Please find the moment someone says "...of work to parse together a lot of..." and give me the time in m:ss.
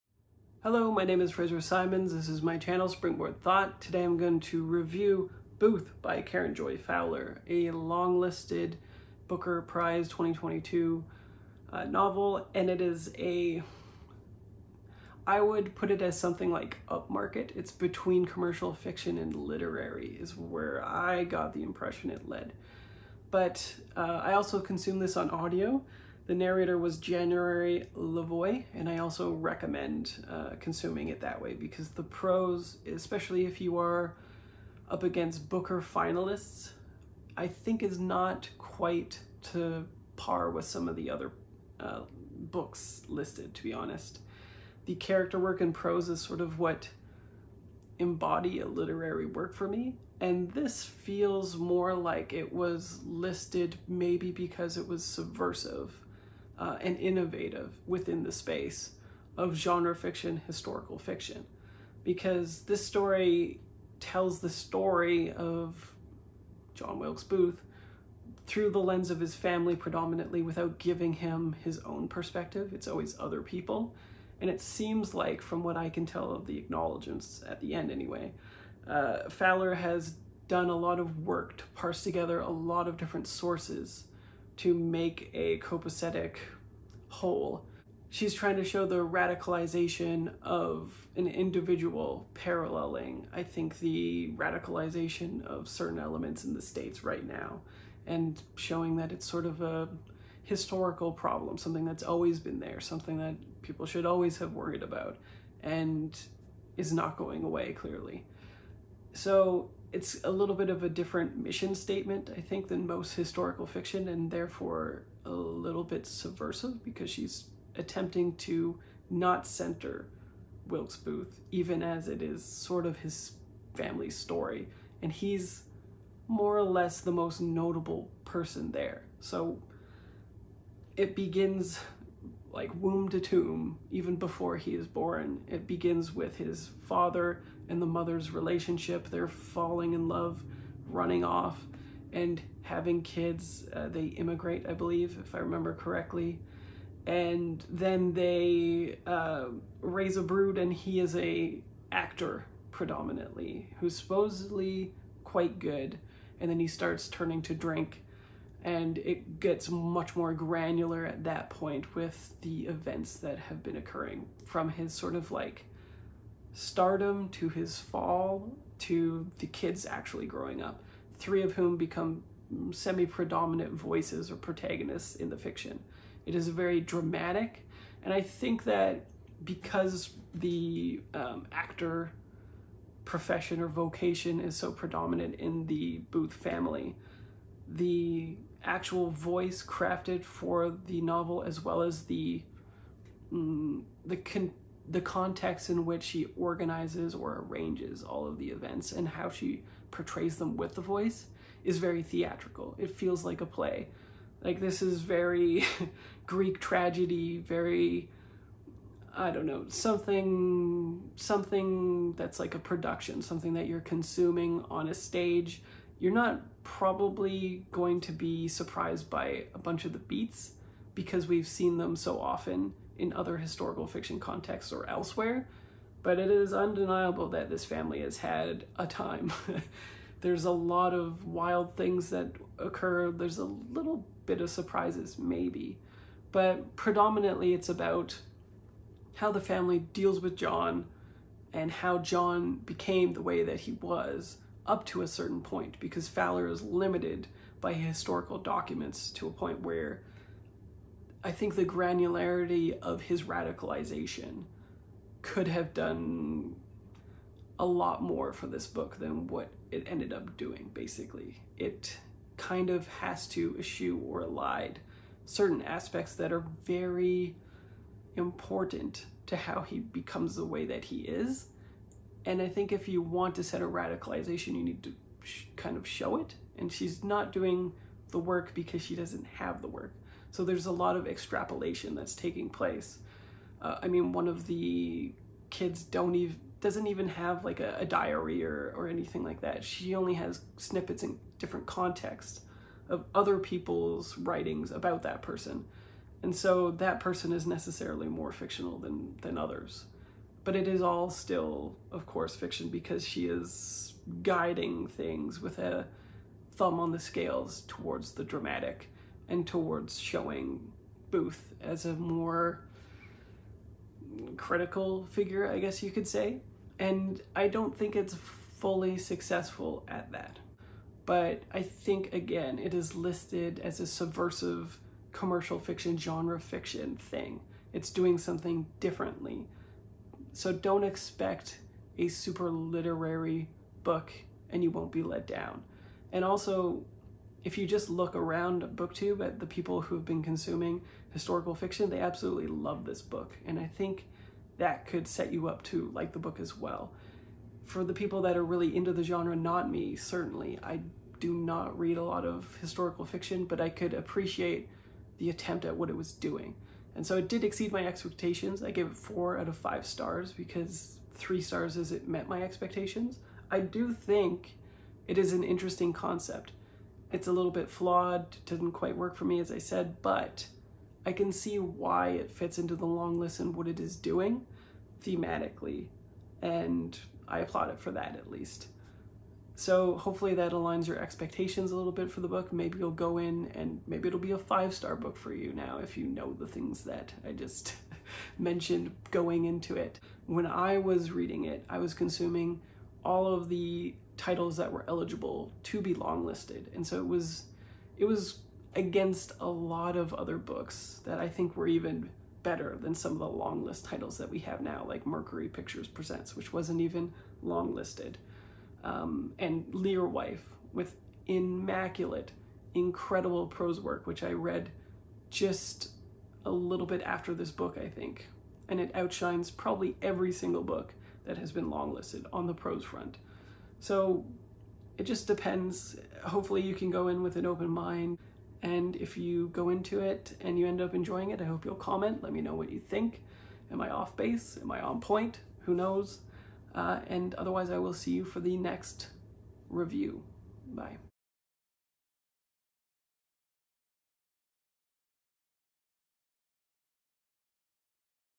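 1:20.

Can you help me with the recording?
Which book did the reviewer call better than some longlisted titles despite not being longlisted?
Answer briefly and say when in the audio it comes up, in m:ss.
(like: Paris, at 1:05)
Mercury Pictures Presents, at 6:45.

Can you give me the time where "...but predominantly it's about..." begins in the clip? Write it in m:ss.
3:56.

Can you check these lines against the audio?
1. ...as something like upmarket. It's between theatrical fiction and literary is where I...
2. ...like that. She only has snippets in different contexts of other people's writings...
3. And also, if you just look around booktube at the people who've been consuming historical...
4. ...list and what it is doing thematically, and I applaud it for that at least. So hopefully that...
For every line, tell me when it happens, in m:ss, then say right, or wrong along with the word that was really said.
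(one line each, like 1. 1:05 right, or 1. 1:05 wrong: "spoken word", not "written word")
1. 0:16 wrong: "commercial", not "theatrical"
2. 4:49 right
3. 5:36 right
4. 6:13 right.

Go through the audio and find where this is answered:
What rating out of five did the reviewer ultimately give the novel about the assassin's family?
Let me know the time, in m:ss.
5:58.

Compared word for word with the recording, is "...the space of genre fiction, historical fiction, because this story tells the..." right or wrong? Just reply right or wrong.
right.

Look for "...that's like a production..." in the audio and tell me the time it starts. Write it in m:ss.
3:32.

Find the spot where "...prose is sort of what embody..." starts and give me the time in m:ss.
0:45.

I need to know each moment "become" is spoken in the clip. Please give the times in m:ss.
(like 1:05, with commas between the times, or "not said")
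2:51, 4:29.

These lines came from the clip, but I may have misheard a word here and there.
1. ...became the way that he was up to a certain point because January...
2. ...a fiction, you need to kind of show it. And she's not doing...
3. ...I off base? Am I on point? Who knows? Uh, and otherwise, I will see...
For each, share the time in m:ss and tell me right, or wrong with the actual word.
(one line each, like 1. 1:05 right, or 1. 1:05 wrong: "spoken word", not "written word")
1. 4:02 wrong: "Fowler", not "January"
2. 4:33 wrong: "radicalization", not "fiction"
3. 7:13 right.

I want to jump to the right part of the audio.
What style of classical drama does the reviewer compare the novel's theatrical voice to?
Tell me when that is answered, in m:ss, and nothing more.
3:26.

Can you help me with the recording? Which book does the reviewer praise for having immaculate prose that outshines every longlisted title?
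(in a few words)
Learwife.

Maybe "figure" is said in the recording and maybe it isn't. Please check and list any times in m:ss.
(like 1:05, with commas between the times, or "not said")
5:15.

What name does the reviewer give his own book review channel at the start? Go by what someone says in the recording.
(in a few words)
Springboard Thought.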